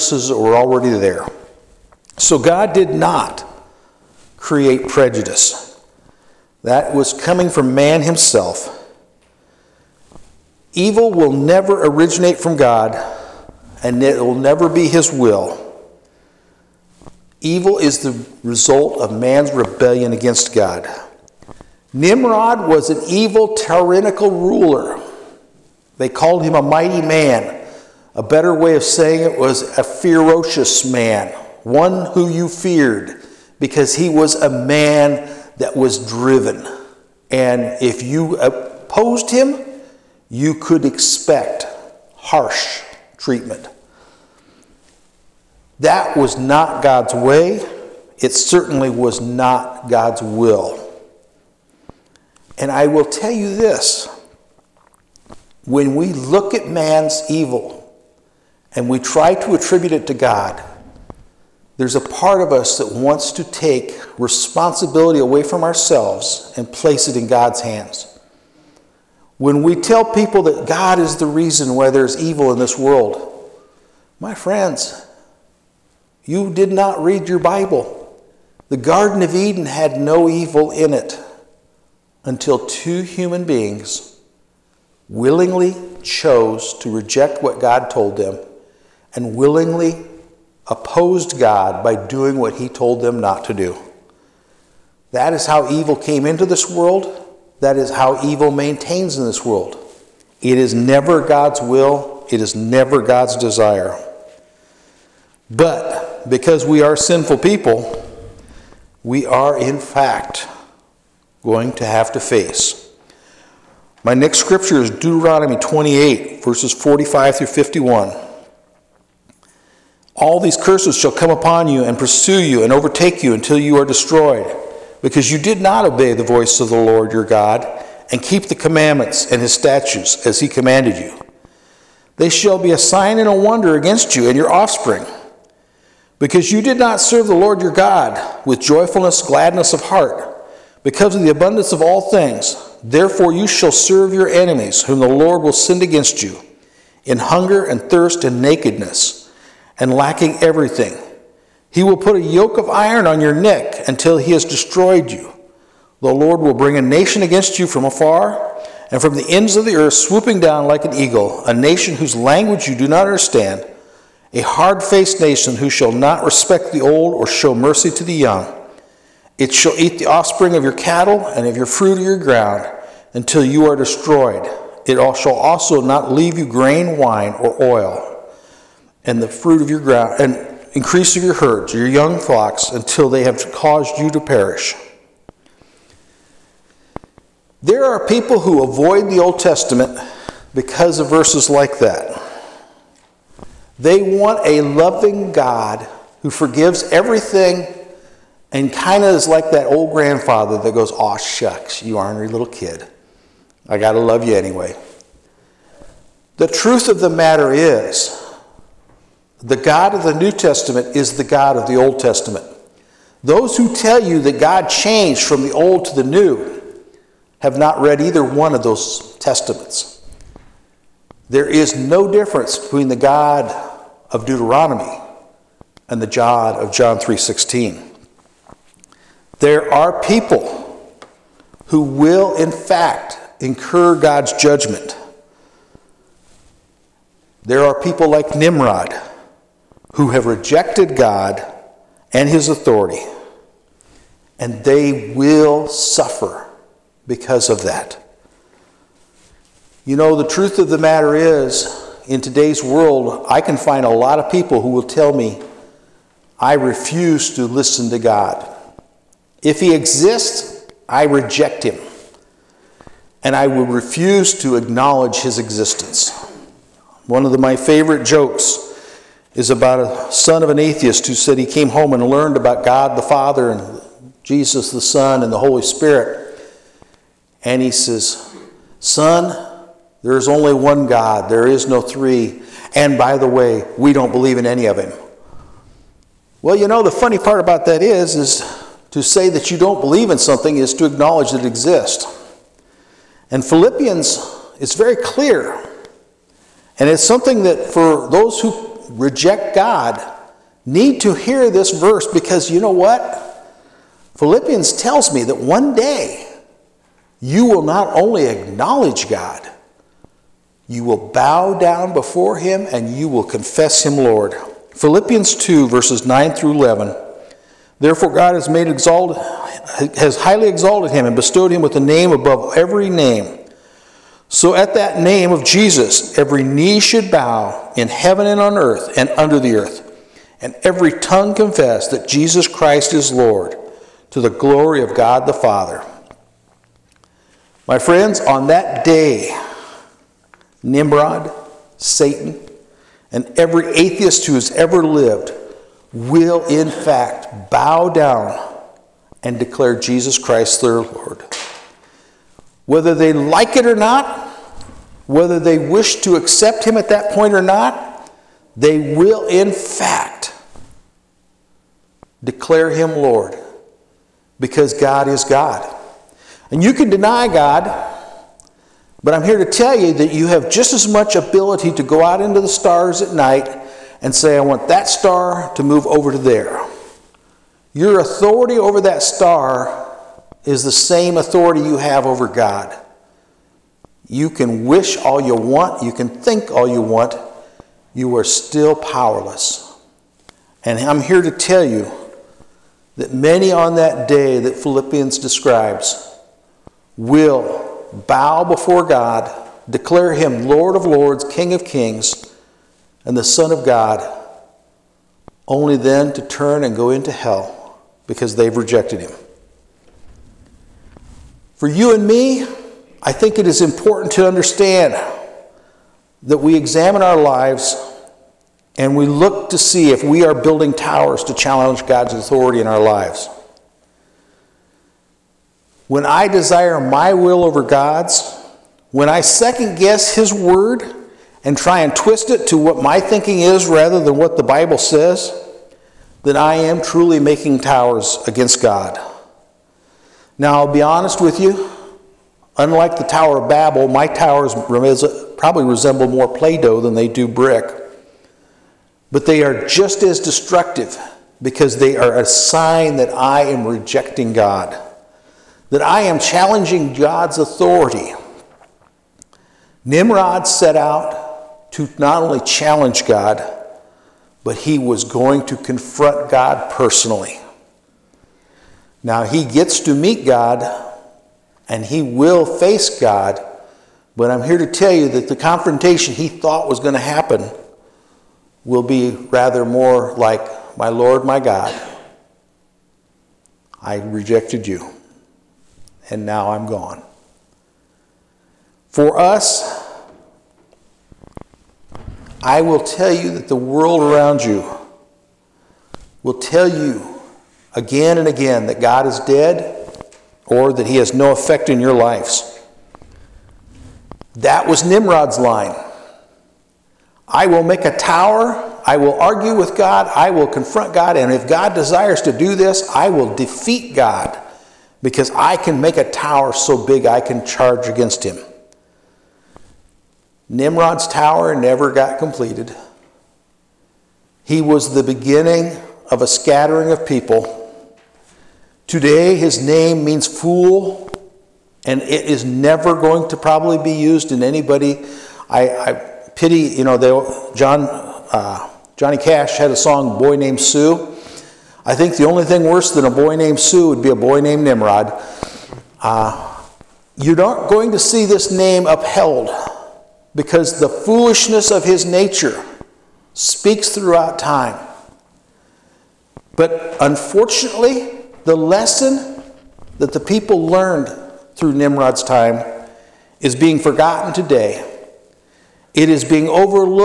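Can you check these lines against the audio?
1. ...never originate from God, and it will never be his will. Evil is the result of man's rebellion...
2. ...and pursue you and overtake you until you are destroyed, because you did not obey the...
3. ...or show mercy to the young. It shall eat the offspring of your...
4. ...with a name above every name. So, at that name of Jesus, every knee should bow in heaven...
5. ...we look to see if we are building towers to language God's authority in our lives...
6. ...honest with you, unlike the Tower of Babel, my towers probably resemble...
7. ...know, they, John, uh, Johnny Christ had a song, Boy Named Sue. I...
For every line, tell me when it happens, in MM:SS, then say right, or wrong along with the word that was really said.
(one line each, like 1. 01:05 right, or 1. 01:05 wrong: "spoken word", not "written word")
1. 00:11 right
2. 02:01 right
3. 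02:47 right
4. 05:21 right
5. 06:58 wrong: "challenge", not "language"
6. 07:20 right
7. 08:56 wrong: "Cash", not "Christ".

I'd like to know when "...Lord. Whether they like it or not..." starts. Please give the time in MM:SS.
05:50.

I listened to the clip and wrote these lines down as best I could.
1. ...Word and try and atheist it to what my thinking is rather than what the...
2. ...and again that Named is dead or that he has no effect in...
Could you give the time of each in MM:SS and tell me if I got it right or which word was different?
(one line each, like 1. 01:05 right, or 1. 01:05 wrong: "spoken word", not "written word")
1. 07:10 wrong: "twist", not "atheist"
2. 08:18 wrong: "God", not "Named".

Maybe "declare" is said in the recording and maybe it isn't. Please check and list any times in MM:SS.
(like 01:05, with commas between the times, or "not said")
05:49, 06:02, 06:39.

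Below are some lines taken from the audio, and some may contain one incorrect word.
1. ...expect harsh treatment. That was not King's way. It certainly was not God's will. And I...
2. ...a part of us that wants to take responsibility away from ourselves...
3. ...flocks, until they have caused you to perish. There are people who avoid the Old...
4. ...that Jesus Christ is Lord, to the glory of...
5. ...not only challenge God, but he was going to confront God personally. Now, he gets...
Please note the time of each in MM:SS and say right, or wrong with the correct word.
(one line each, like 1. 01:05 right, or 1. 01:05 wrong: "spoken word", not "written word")
1. 00:40 wrong: "God", not "King"
2. 01:01 right
3. 03:02 right
4. 05:31 right
5. 07:41 right.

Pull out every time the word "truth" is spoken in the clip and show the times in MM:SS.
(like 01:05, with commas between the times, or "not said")
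03:26, 04:10.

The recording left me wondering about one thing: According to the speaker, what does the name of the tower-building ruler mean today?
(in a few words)
Fool.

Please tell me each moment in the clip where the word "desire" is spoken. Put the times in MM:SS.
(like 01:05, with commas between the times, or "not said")
01:43, 07:06, 08:31.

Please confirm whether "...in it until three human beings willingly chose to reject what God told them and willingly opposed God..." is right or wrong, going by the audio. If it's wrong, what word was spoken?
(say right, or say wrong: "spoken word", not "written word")
wrong: "two", not "three".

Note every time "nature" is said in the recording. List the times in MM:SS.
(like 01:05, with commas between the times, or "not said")
09:12.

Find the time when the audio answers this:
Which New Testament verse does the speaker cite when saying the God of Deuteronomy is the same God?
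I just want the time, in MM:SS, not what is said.
03:46.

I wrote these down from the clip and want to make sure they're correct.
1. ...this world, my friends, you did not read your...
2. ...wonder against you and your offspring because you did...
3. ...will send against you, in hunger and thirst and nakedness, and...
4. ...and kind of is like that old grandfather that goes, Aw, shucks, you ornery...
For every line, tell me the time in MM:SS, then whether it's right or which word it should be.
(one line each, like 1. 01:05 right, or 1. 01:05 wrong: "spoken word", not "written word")
1. 01:12 right
2. 02:13 right
3. 02:25 right
4. 03:18 right.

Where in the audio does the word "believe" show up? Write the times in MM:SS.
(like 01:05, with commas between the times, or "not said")
04:44, 04:49.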